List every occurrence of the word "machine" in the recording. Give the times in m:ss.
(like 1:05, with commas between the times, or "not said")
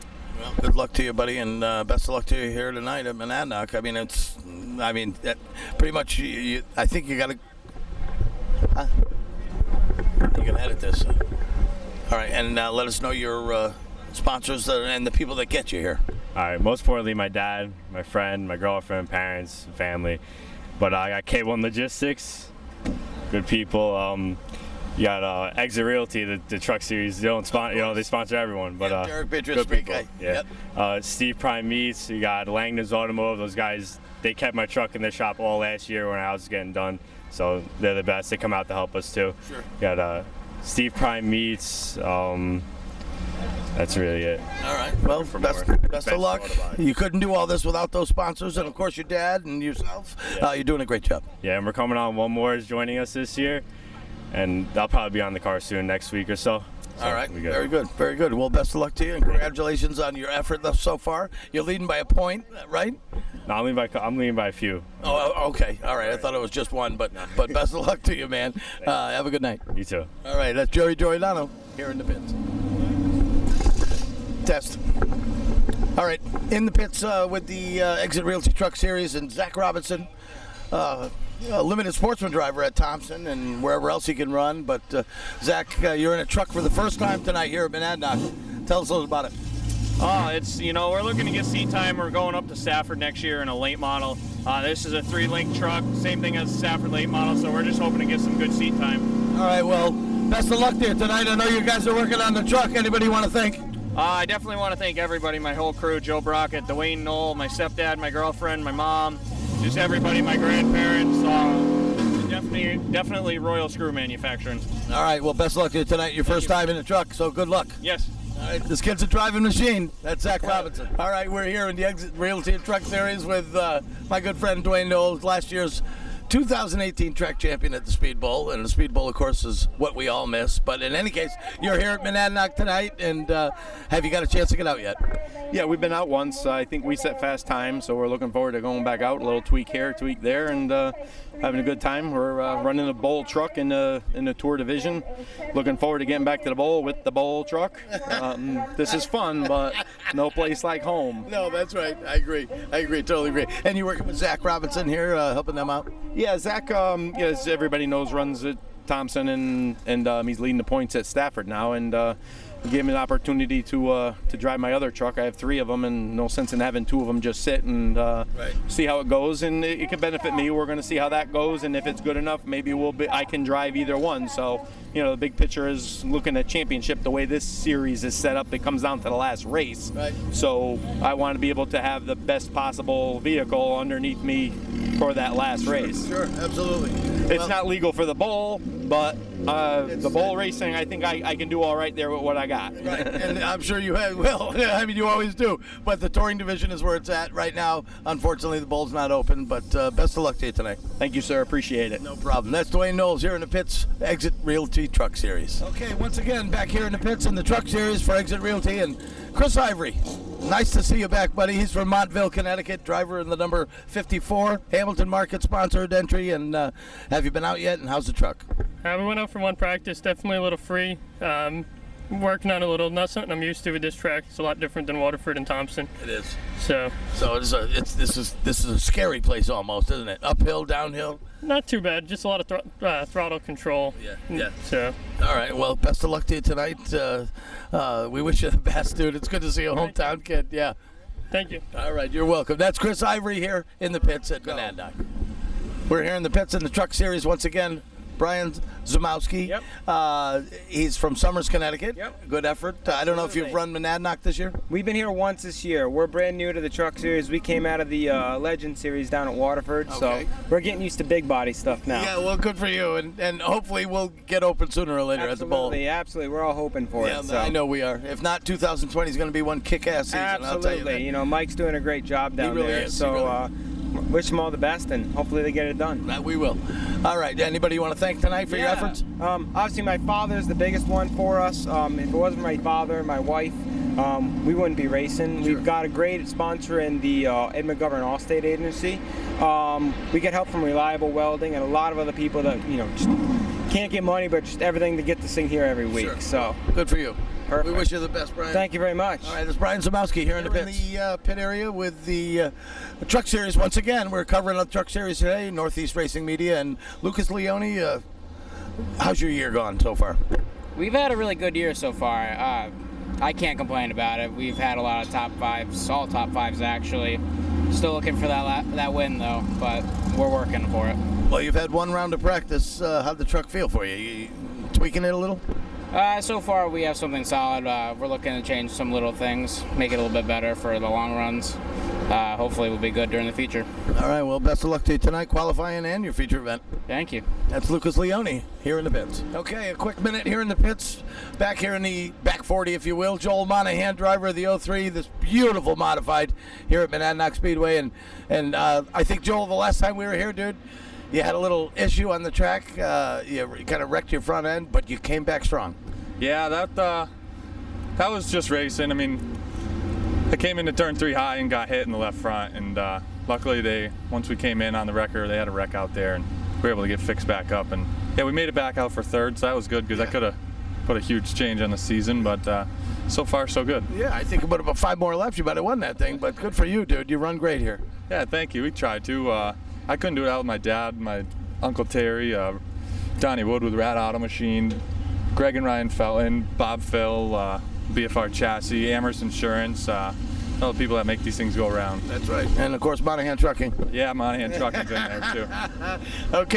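1:59, 6:24.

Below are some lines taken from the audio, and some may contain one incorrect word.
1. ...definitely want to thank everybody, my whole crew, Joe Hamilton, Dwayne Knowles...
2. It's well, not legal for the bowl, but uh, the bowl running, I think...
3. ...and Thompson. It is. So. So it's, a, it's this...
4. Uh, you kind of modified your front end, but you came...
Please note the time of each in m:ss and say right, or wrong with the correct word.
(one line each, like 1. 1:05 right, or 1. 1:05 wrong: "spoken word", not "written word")
1. 1:44 wrong: "Brockett", not "Hamilton"
2. 3:06 wrong: "racing", not "running"
3. 3:45 right
4. 5:52 wrong: "wrecked", not "modified".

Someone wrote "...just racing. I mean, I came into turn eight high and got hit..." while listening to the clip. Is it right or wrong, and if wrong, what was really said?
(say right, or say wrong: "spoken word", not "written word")
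wrong: "three", not "eight".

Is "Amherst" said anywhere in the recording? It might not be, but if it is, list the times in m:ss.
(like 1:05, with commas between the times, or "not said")
6:28.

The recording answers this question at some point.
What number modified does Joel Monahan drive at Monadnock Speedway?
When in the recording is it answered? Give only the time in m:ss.
5:44.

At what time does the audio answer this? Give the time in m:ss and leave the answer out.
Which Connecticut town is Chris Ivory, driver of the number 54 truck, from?
3:31.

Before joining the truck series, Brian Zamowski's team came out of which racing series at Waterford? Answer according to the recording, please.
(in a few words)
Legend series.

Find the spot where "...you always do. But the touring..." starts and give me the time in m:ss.
3:14.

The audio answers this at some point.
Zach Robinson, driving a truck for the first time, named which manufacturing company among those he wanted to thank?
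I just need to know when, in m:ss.
1:53.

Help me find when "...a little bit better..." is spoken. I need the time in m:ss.
5:29.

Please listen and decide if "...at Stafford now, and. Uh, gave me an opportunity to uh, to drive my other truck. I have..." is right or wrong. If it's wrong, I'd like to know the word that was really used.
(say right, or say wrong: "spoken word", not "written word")
right.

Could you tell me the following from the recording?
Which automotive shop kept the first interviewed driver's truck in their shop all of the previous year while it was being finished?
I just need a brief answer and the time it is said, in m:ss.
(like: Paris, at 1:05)
Langdon's Automotive, at 0:32.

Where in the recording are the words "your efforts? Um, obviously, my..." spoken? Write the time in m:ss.
4:38.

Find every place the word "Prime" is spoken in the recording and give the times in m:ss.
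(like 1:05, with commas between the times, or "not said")
0:31, 0:40.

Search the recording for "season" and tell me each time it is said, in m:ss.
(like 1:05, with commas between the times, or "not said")
4:30, 6:11.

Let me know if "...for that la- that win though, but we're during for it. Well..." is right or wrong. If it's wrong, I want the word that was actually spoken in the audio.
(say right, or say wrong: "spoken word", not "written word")
wrong: "working", not "during".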